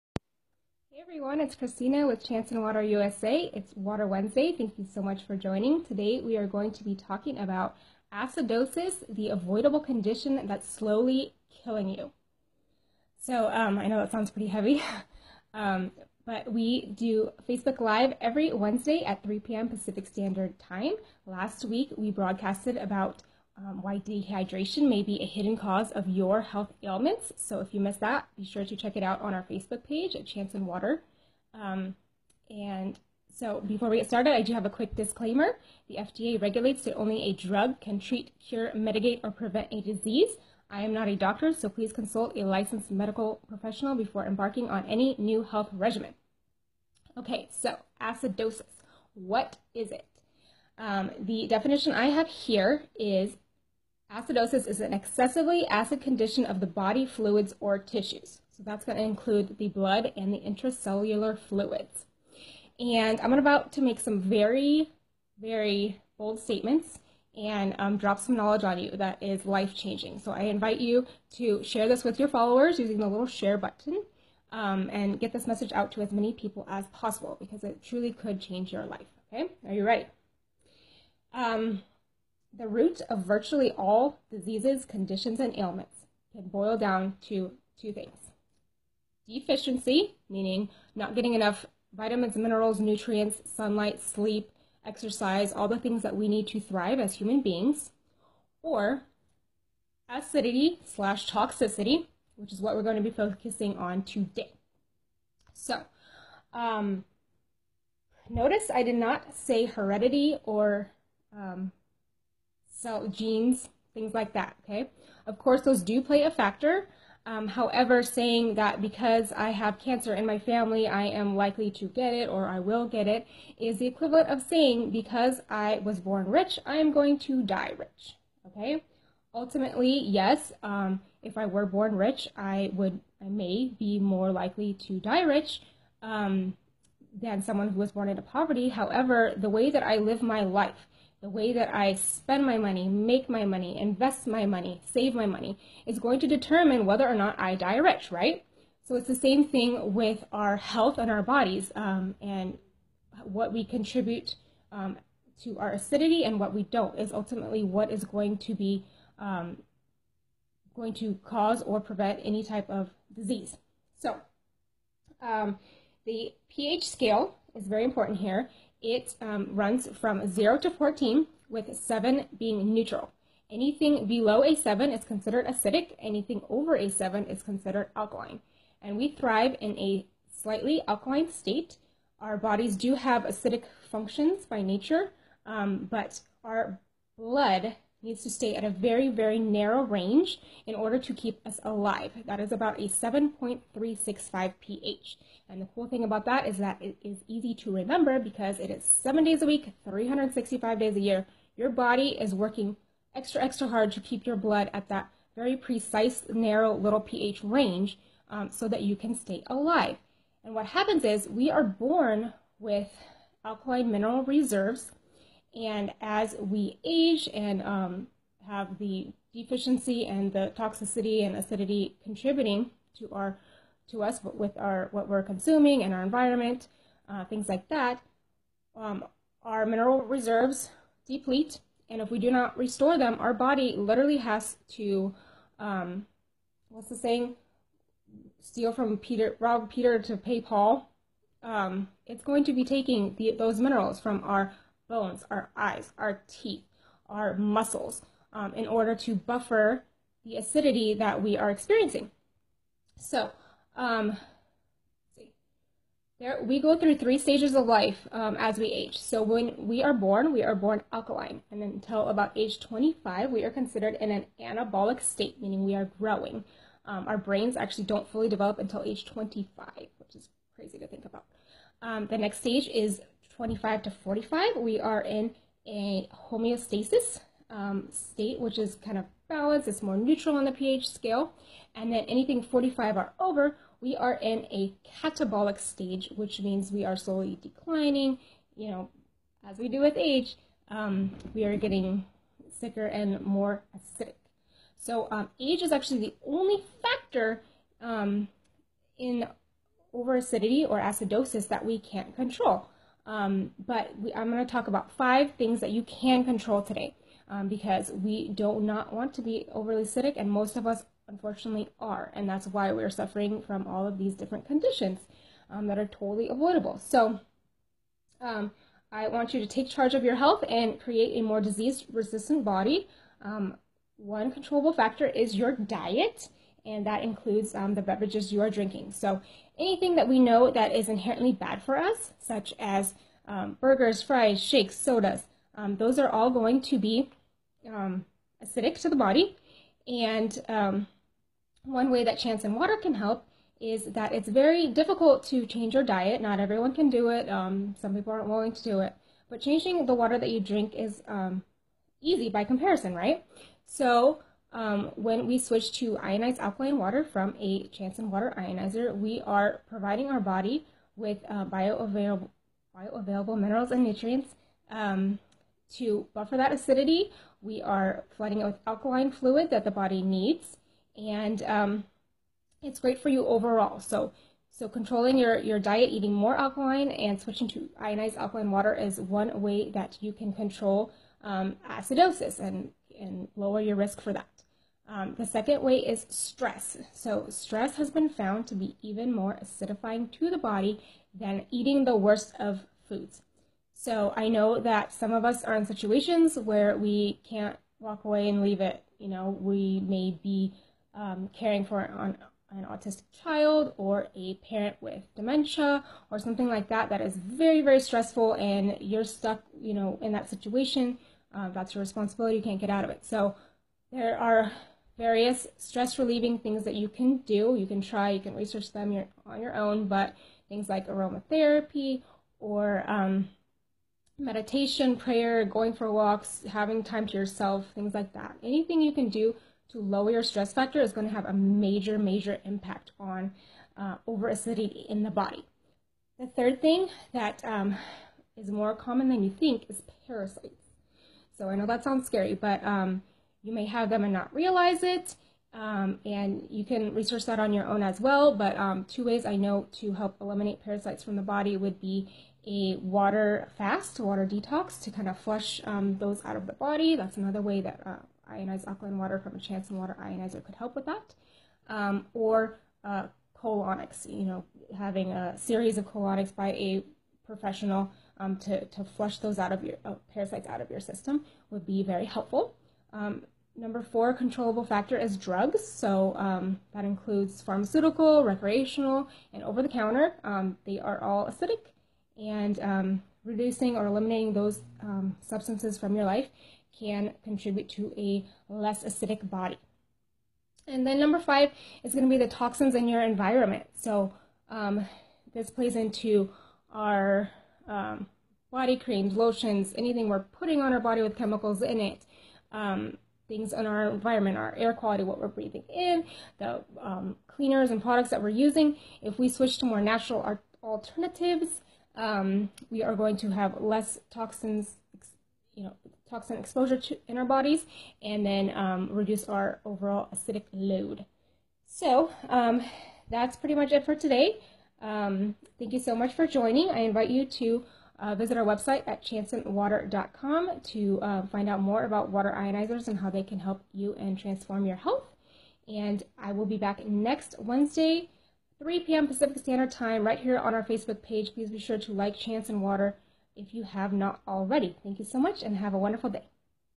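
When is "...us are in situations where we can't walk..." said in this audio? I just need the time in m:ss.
6:35.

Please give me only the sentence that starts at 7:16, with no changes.
The third thing that um, is more common than you think is parasites.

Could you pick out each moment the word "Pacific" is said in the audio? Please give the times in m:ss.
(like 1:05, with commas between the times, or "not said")
0:19, 8:59.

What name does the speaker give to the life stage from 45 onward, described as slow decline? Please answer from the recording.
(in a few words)
Catabolic.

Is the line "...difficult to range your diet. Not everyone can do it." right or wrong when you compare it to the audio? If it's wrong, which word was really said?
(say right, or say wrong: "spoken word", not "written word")
wrong: "change", not "range".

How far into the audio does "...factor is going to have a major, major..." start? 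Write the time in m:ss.
7:10.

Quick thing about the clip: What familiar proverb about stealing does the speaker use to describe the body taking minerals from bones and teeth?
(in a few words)
Rob Peter to pay Paul.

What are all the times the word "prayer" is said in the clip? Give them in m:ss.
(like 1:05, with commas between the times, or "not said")
7:04.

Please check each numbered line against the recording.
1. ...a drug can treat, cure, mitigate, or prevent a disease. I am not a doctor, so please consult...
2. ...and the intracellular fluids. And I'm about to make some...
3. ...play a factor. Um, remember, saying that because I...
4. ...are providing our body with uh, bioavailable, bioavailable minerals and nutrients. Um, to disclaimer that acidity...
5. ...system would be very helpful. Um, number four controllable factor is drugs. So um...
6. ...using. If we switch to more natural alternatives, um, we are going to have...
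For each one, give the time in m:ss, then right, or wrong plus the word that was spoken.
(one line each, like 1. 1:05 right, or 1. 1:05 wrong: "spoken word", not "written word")
1. 0:37 right
2. 1:00 right
3. 1:56 wrong: "however", not "remember"
4. 5:59 wrong: "buffer", not "disclaimer"
5. 7:50 right
6. 8:28 right.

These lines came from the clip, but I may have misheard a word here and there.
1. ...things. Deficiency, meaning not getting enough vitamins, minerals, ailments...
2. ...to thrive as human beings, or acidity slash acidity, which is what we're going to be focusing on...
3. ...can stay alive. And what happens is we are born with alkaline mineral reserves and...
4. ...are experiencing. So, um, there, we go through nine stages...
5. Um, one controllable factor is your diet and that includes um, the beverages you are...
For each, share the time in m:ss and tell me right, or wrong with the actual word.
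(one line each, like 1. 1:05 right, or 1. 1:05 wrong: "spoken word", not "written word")
1. 1:27 wrong: "nutrients", not "ailments"
2. 1:36 wrong: "toxicity", not "acidity"
3. 3:28 right
4. 4:11 wrong: "three", not "nine"
5. 5:23 right.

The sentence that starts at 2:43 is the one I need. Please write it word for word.
So um, the pH scale is very important here it um, runs from 0 to 14, with 7 being neutral.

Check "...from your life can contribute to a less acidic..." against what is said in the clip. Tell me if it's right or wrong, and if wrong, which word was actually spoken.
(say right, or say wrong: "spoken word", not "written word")
right.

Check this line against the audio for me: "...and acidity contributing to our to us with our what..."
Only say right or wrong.
right.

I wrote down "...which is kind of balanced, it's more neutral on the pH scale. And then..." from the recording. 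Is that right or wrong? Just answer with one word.
right.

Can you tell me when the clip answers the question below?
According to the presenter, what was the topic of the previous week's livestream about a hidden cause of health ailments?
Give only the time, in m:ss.
0:23.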